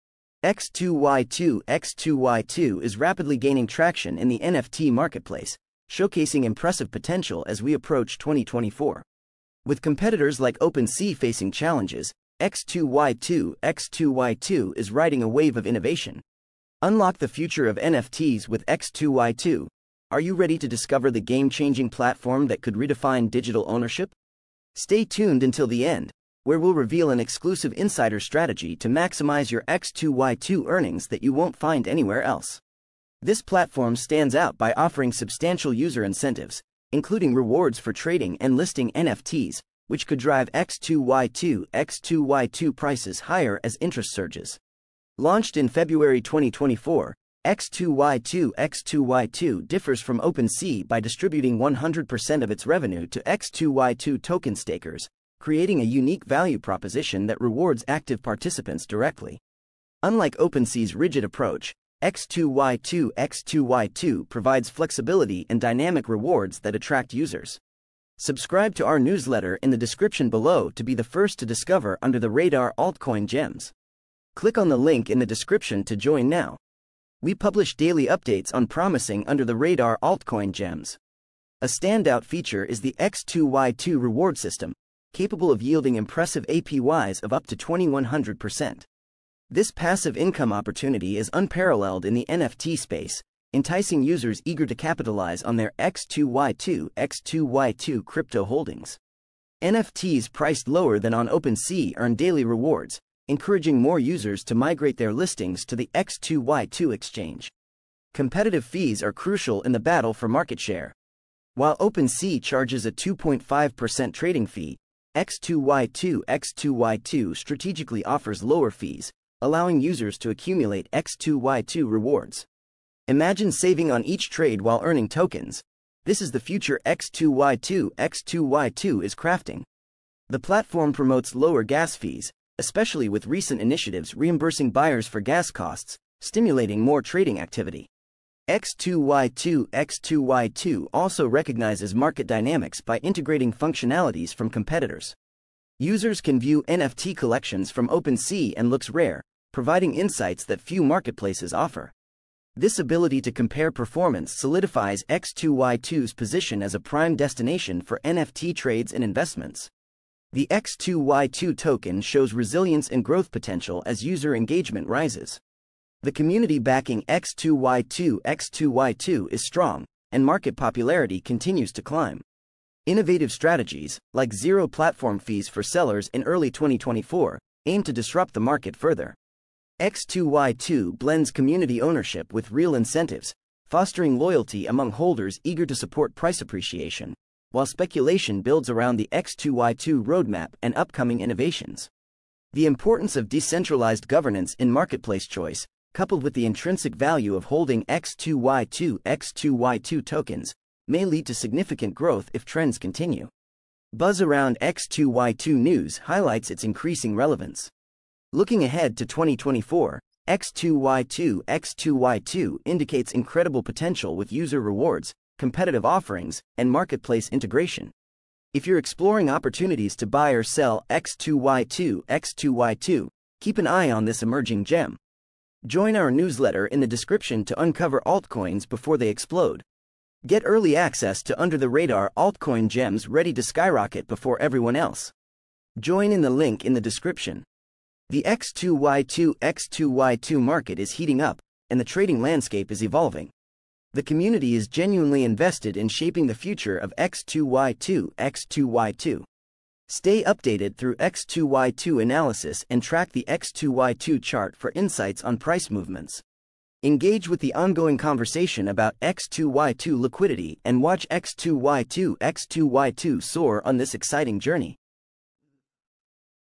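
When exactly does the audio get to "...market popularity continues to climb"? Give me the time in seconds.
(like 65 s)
170 s.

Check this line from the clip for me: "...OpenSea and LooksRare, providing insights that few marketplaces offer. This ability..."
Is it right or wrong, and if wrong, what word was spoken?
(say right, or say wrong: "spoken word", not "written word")
right.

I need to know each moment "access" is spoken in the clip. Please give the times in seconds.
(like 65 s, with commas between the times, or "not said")
230 s.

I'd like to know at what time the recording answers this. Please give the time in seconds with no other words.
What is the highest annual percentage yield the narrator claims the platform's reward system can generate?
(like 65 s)
87 s.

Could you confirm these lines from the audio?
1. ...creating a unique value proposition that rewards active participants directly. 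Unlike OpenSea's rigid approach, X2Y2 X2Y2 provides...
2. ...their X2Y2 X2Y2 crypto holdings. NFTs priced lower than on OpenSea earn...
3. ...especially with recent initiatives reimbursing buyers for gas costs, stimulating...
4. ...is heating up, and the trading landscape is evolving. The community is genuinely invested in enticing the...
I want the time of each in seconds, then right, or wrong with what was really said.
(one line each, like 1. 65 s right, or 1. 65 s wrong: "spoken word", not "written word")
1. 55 s right
2. 95 s right
3. 132 s right
4. 240 s wrong: "shaping", not "enticing".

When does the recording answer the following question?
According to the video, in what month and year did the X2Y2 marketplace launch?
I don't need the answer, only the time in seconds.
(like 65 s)
45 s.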